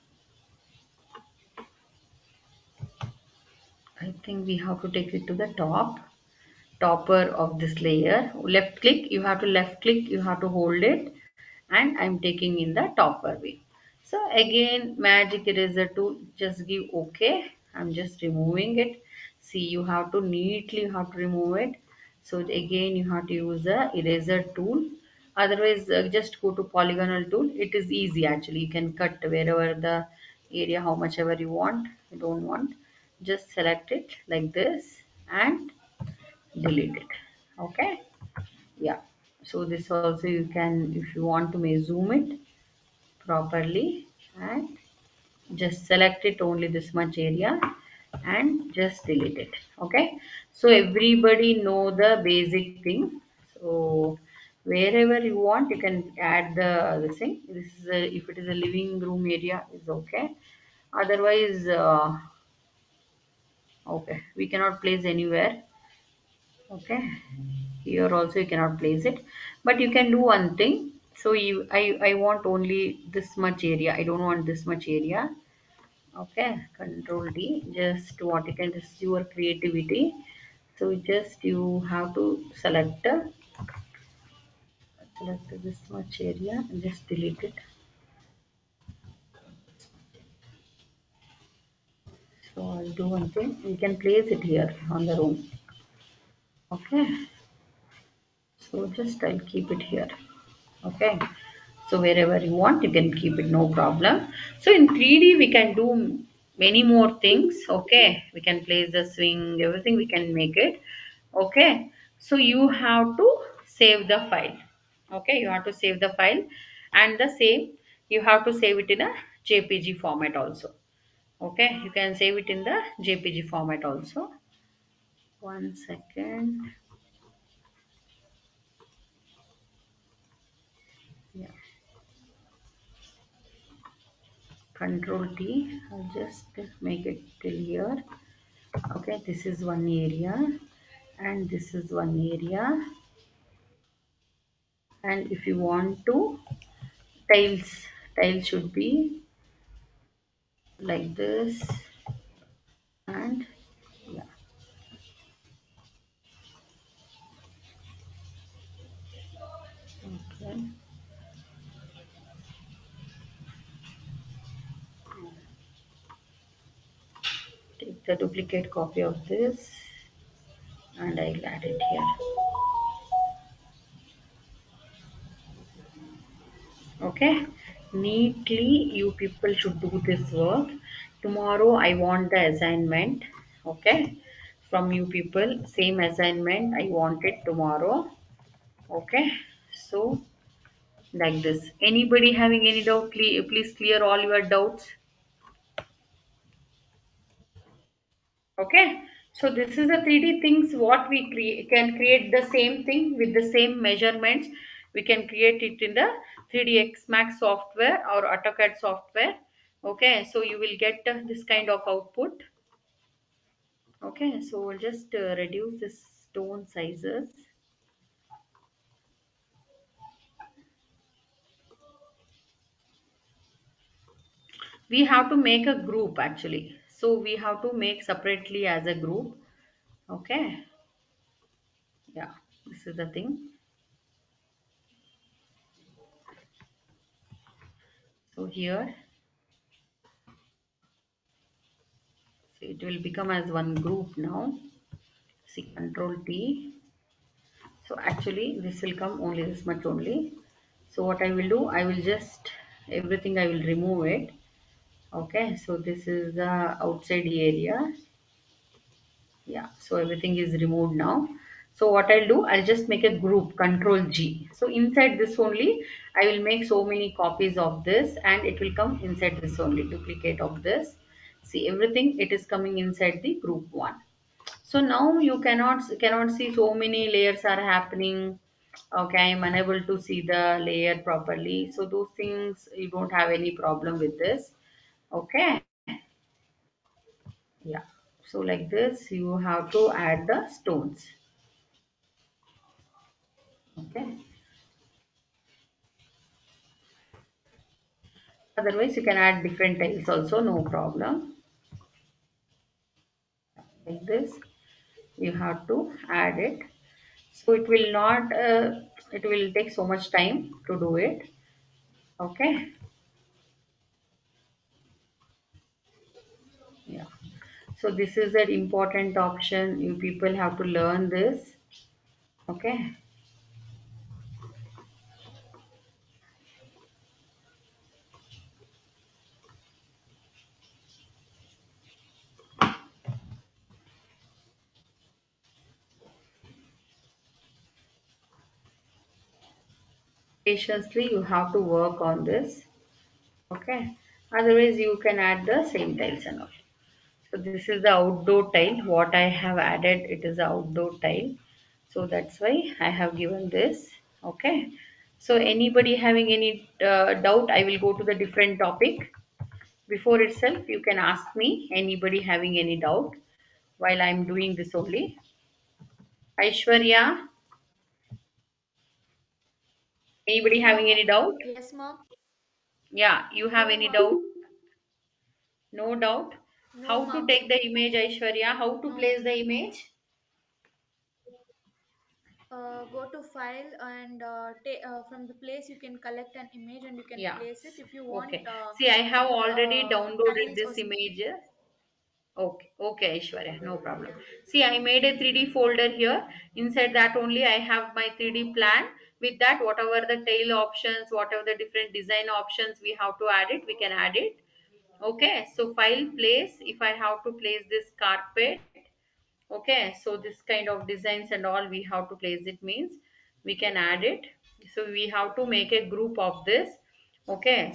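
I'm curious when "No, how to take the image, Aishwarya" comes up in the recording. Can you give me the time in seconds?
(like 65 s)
376 s.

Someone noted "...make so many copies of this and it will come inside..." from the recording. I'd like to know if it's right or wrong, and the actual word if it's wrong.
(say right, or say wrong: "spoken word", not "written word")
right.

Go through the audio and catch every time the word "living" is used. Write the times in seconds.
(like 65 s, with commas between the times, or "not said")
58 s.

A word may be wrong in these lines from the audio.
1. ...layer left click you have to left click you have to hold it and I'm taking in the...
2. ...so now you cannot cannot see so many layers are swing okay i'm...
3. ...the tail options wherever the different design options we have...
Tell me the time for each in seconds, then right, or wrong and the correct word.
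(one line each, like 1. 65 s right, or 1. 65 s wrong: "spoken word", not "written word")
1. 7 s right
2. 274 s wrong: "happening", not "swing"
3. 400 s wrong: "whatever", not "wherever".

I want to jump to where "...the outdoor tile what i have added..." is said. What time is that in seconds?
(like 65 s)
347 s.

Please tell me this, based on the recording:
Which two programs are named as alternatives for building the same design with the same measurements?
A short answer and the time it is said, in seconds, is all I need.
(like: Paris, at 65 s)
3ds Max and AutoCAD, at 206 s.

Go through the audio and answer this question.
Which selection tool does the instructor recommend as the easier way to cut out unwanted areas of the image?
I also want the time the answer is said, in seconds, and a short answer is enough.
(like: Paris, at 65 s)
polygonal tool, at 26 s.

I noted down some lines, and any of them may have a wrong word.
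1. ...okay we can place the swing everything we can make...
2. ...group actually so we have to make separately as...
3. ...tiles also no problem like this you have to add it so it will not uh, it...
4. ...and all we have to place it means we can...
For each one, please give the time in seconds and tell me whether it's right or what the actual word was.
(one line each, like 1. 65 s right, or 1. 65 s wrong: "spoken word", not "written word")
1. 107 s right
2. 225 s right
3. 299 s right
4. 411 s right.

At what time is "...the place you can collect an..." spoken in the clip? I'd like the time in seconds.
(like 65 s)
385 s.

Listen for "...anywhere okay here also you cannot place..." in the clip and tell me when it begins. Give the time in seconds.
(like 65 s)
65 s.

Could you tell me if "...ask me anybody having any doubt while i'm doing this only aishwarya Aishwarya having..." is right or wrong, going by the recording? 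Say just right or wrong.
wrong.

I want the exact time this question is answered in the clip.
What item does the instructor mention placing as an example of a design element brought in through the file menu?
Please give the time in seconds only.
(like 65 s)
408 s.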